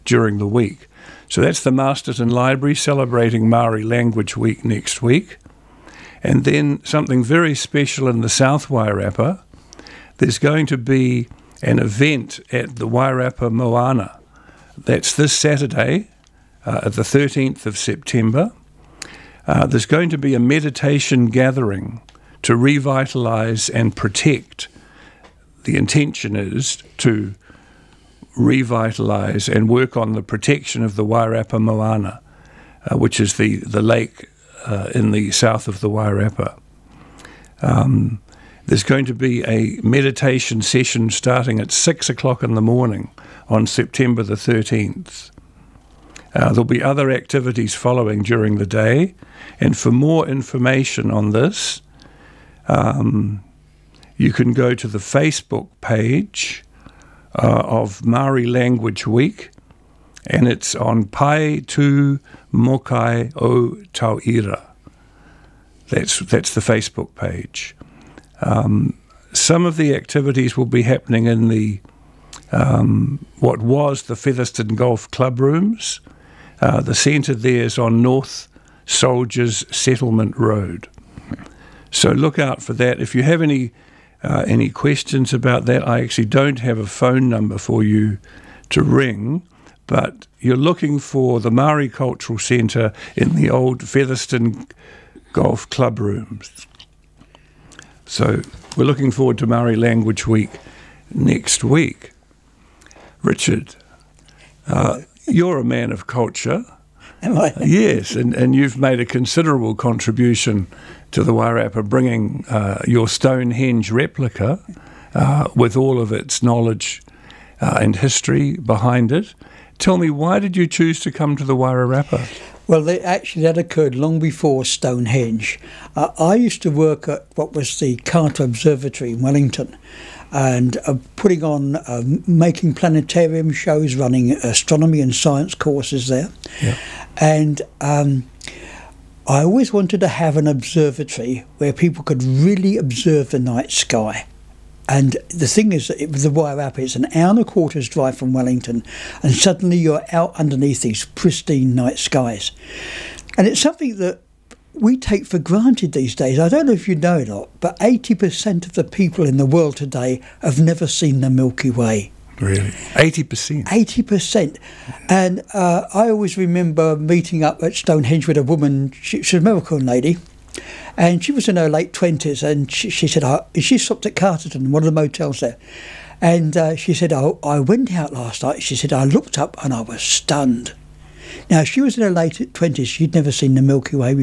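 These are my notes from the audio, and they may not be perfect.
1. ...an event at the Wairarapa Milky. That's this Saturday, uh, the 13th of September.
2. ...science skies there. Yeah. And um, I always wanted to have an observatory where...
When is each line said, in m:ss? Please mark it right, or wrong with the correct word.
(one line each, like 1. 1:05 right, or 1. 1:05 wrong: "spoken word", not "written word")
1. 0:11 wrong: "Moana", not "Milky"
2. 2:15 wrong: "courses", not "skies".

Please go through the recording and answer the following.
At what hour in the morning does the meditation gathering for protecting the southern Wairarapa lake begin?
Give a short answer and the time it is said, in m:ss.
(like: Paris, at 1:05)
6 o'clock, at 0:41.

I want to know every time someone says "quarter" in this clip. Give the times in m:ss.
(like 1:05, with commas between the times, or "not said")
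2:27.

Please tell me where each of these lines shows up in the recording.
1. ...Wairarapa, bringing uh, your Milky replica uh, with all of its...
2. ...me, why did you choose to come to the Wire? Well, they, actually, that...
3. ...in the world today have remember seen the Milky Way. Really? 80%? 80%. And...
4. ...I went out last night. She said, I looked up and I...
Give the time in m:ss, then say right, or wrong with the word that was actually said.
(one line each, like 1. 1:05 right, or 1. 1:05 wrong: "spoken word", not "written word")
1. 1:51 wrong: "Stonehenge", not "Milky"
2. 1:59 wrong: "Wairarapa", not "Wire"
3. 2:39 wrong: "never", not "remember"
4. 2:57 right.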